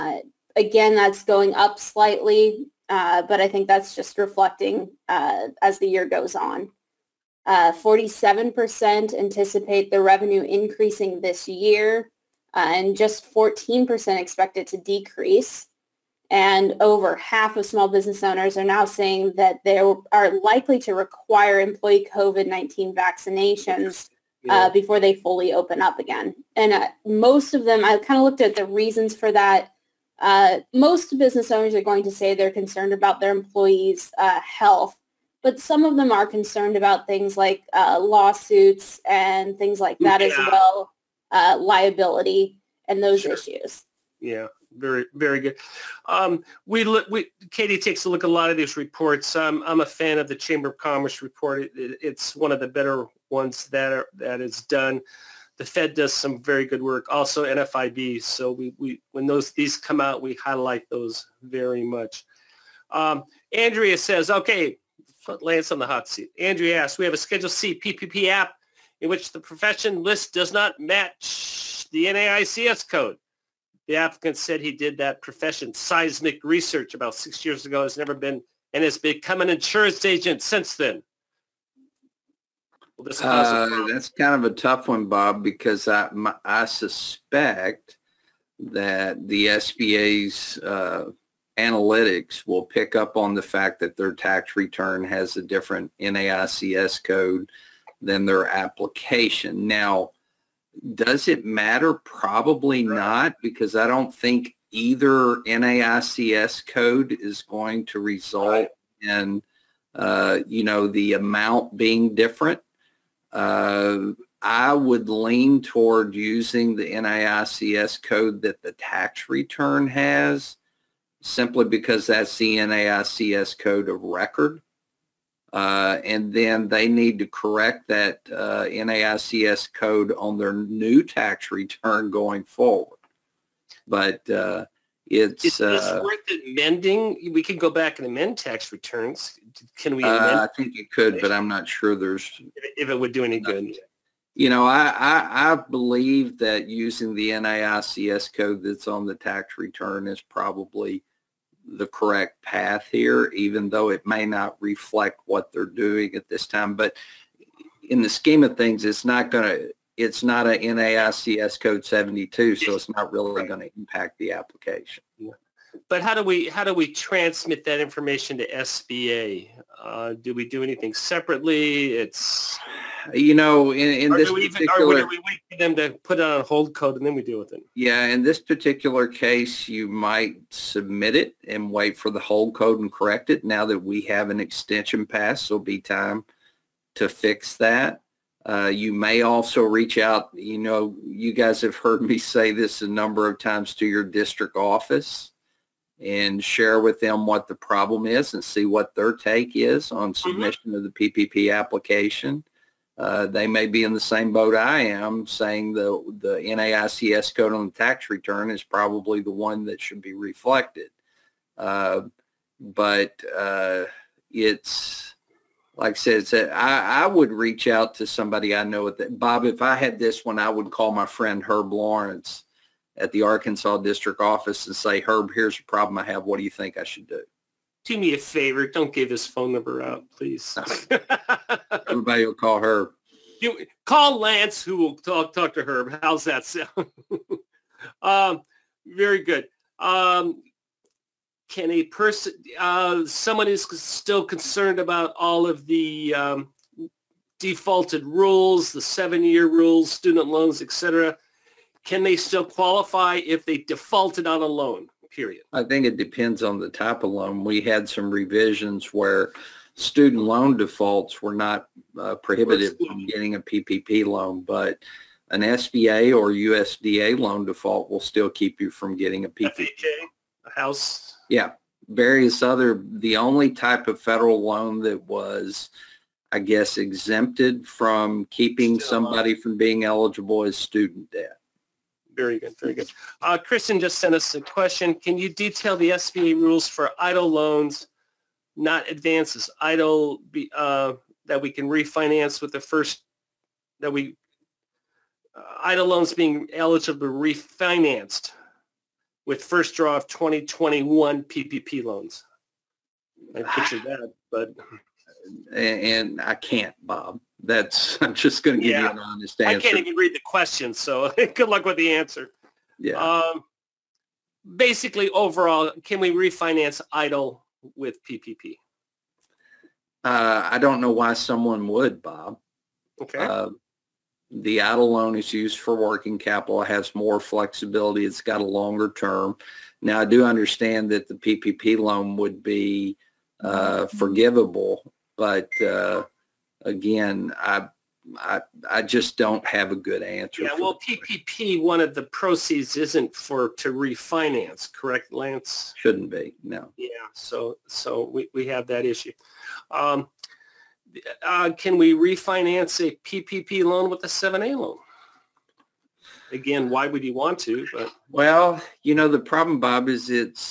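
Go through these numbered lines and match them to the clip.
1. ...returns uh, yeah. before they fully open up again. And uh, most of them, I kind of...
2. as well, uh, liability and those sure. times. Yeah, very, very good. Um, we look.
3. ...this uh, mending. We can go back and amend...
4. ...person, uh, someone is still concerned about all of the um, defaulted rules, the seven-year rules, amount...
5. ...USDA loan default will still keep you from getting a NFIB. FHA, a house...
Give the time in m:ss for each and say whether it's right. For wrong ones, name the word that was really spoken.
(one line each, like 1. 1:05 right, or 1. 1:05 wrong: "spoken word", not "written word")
1. 0:22 wrong: "vaccinations", not "returns"
2. 0:40 wrong: "issues", not "times"
3. 2:15 right
4. 4:01 wrong: "student", not "amount"
5. 4:26 wrong: "PPP", not "NFIB".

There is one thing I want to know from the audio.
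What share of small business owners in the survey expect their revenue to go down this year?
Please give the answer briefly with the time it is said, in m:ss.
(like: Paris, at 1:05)
14%, at 0:13.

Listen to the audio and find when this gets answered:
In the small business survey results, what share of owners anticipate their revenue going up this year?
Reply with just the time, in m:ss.
0:07.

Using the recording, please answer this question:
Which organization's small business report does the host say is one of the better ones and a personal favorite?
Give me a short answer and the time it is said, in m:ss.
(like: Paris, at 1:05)
Chamber of Commerce, at 0:50.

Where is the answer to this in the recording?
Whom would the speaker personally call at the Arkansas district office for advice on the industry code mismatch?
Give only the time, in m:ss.
3:41.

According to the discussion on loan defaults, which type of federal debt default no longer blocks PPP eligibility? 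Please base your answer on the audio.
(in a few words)
student debt.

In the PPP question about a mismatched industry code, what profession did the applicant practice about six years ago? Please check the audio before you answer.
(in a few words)
seismic research.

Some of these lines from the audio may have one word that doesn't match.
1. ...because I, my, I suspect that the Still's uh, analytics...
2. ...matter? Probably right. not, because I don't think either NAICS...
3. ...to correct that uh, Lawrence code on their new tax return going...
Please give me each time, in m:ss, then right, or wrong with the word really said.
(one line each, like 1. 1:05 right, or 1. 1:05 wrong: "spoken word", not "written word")
1. 1:25 wrong: "SBA", not "Still"
2. 1:41 right
3. 2:07 wrong: "NAICS", not "Lawrence".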